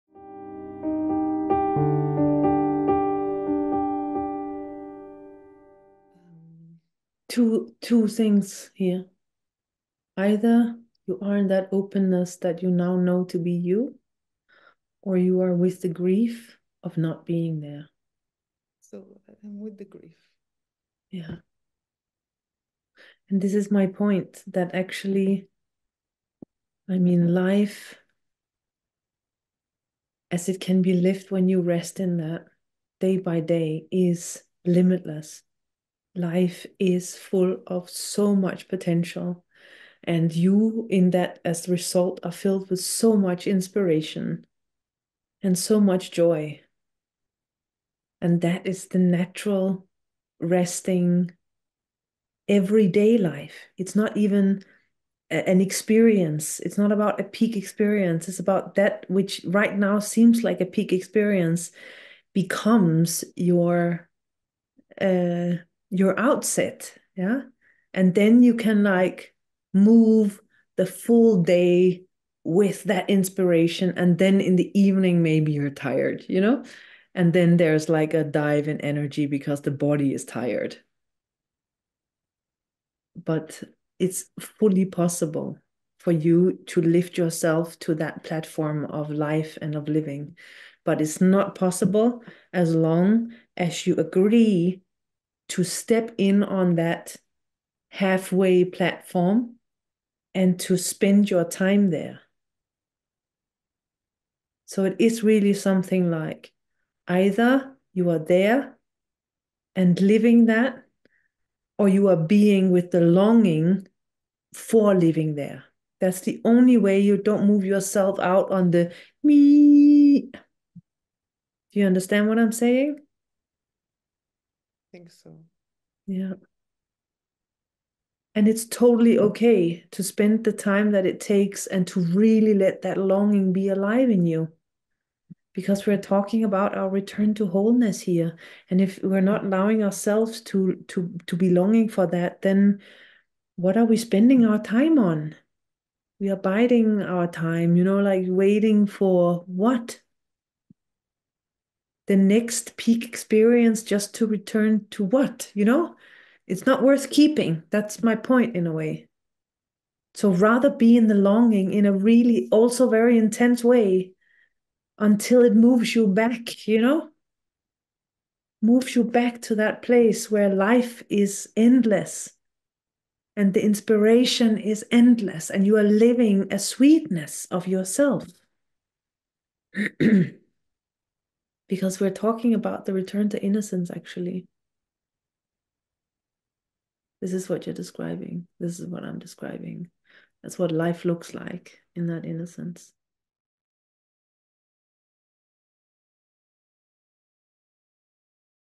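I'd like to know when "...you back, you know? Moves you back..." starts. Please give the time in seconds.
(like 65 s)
165 s.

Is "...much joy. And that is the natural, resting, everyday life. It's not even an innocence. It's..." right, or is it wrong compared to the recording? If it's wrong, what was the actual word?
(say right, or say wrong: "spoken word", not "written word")
wrong: "experience", not "innocence".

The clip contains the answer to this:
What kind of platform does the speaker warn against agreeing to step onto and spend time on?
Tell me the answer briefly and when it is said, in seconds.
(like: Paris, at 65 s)
halfway, at 97 s.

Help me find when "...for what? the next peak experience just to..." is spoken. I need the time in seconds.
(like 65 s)
148 s.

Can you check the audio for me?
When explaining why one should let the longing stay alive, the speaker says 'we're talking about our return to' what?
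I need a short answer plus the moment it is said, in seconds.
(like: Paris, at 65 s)
wholeness, at 137 s.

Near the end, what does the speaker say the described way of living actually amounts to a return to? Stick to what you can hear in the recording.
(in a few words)
the return to innocence.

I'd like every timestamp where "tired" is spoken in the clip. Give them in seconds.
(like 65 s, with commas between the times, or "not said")
75 s, 80 s.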